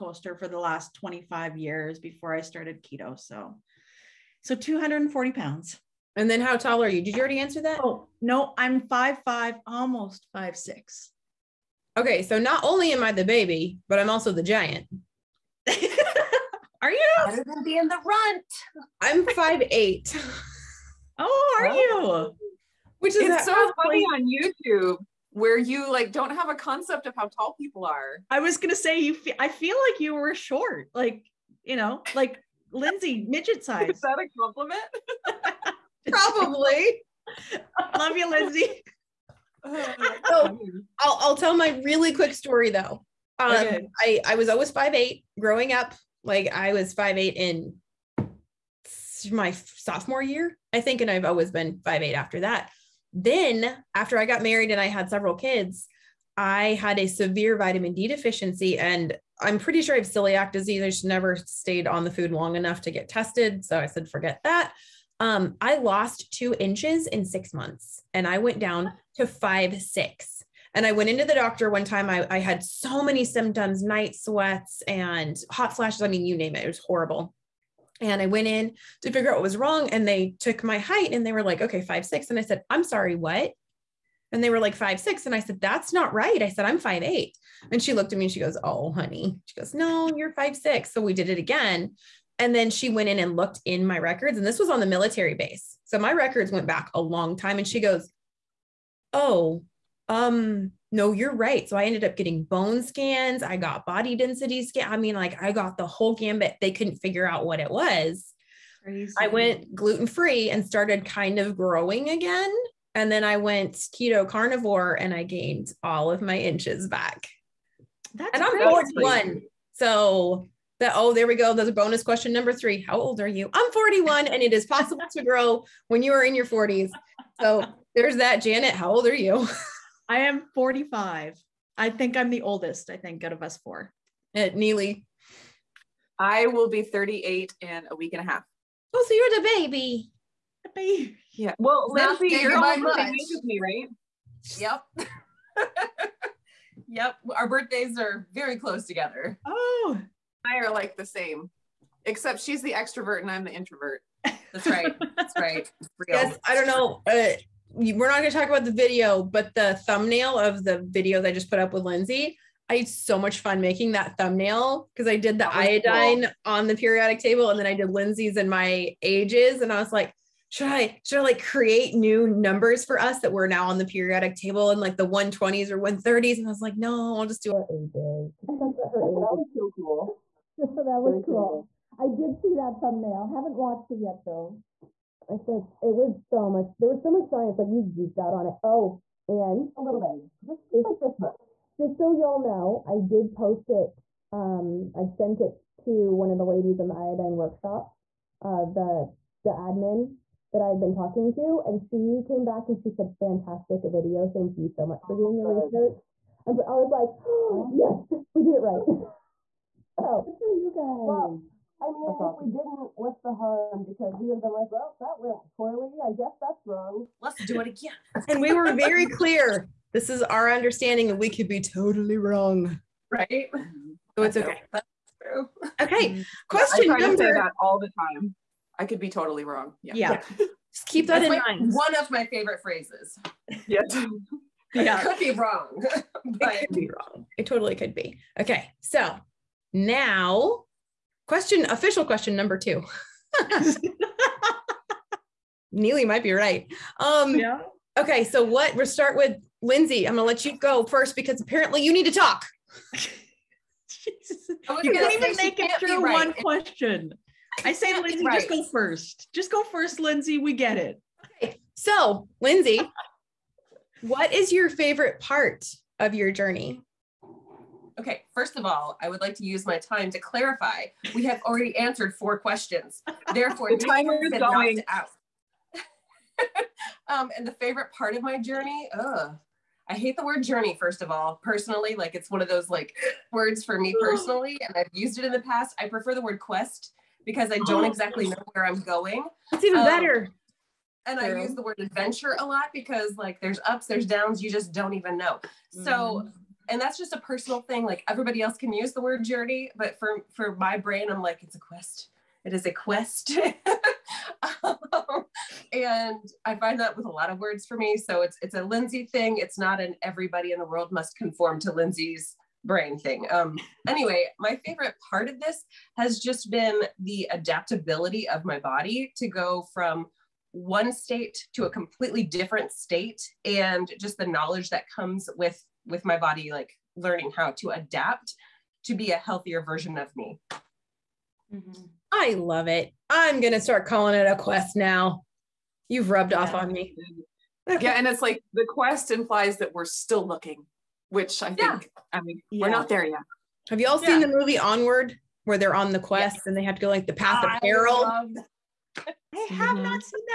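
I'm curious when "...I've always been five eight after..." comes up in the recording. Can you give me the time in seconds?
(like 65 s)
51 s.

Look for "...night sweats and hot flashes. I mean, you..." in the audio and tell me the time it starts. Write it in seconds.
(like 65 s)
73 s.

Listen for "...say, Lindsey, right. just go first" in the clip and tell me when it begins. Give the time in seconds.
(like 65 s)
257 s.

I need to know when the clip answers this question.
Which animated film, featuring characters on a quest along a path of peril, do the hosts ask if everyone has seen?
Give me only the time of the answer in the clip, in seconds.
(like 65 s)
344 s.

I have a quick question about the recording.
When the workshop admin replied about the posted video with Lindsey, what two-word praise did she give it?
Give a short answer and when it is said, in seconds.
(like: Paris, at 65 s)
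Fantastic video, at 203 s.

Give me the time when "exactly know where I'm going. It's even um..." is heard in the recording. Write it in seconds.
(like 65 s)
287 s.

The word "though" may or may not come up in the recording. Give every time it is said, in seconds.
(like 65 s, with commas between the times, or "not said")
42 s, 184 s.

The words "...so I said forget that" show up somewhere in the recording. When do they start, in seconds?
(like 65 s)
63 s.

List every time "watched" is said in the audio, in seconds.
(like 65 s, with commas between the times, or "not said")
183 s.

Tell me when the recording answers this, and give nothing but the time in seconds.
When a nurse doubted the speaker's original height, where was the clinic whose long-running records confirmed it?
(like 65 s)
94 s.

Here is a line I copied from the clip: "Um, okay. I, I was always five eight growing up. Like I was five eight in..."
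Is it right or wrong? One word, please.
right.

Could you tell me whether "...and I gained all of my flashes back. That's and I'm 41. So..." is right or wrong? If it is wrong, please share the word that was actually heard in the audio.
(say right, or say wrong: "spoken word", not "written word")
wrong: "inches", not "flashes".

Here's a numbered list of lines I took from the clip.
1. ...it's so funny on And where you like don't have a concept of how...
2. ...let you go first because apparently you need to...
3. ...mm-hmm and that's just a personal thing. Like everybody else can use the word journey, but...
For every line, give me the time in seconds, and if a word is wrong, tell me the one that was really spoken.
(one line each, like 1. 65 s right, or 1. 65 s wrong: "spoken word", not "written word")
1. 23 s wrong: "YouTube", not "And"
2. 250 s right
3. 295 s right.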